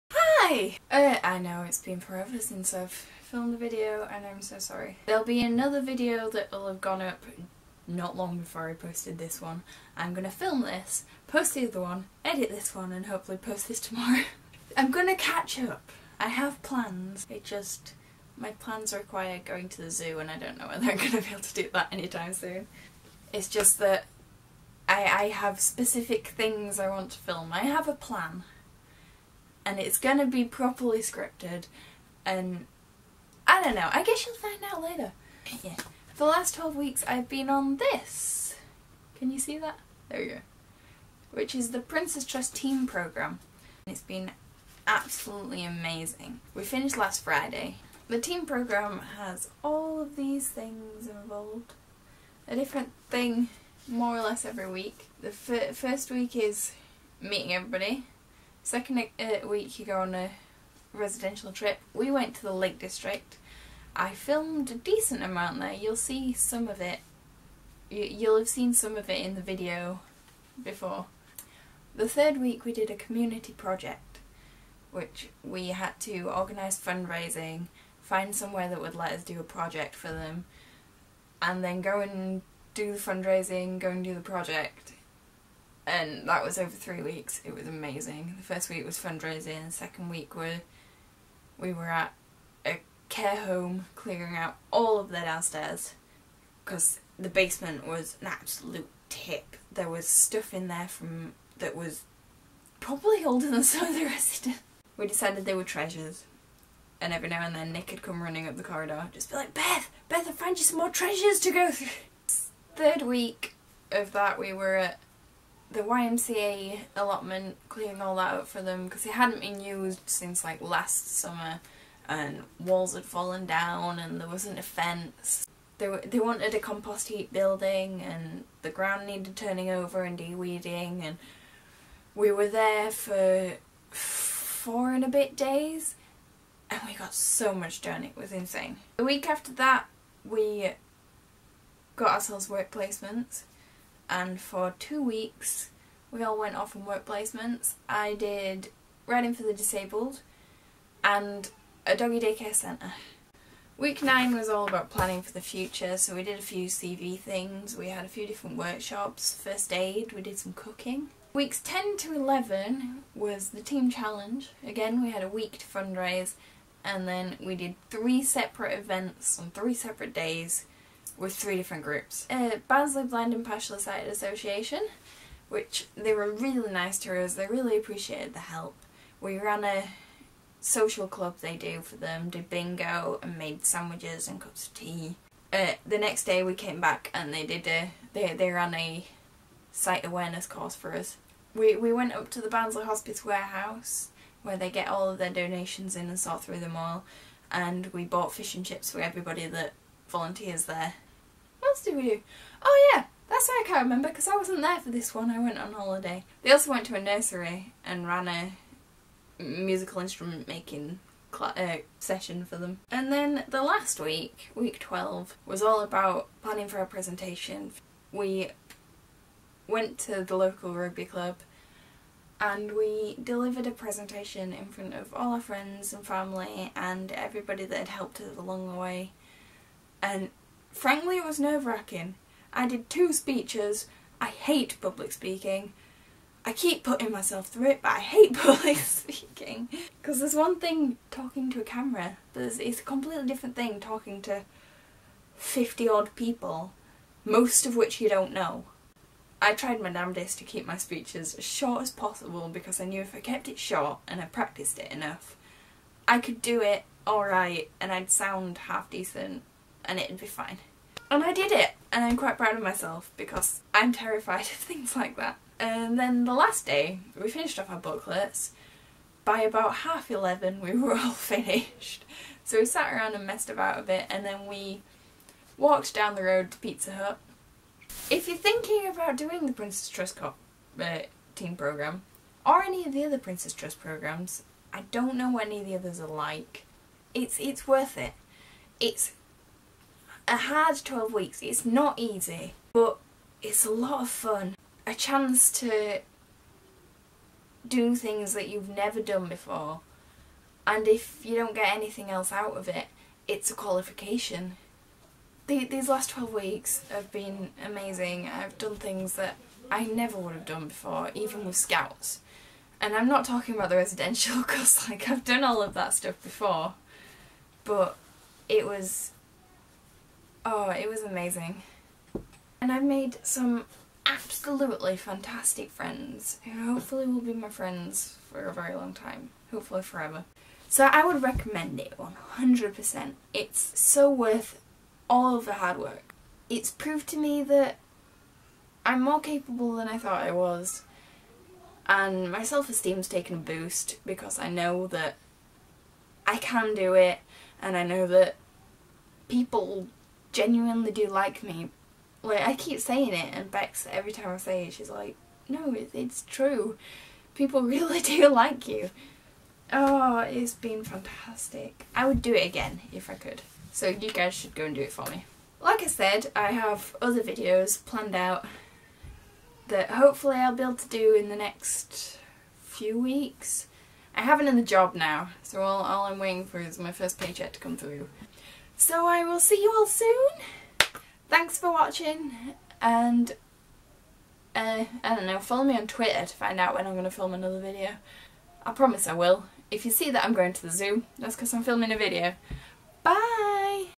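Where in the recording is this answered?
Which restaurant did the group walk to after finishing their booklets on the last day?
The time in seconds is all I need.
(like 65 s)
276 s.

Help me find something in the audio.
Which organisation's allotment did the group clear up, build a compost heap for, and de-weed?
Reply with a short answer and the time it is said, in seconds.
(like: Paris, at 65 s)
YMCA, at 115 s.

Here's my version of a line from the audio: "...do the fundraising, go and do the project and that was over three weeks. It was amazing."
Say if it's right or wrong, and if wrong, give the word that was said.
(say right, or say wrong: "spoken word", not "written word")
right.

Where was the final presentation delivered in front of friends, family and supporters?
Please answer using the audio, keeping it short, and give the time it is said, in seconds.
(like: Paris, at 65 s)
Local rugby club, at 220 s.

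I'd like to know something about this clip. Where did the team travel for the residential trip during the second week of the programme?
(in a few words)
Lake District.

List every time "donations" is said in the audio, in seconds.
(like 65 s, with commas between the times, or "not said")
195 s.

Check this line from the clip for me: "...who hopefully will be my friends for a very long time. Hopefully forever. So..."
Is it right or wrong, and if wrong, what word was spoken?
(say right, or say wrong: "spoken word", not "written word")
right.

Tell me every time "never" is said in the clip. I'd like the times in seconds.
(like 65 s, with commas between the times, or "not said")
298 s, 309 s.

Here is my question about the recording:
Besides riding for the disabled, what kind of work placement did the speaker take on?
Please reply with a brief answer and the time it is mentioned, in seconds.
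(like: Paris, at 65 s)
Doggy daycare centre, at 151 s.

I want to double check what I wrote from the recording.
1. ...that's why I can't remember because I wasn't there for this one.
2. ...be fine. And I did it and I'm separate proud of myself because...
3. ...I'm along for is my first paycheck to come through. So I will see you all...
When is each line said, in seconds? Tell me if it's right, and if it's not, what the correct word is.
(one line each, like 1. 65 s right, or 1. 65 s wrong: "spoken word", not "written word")
1. 203 s right
2. 260 s wrong: "quite", not "separate"
3. 376 s wrong: "waiting", not "along".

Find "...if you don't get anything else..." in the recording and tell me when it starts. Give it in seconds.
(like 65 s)
300 s.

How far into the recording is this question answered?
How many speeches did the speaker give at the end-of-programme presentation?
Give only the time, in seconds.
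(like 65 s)
232 s.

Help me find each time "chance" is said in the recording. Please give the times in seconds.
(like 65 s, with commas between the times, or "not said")
294 s.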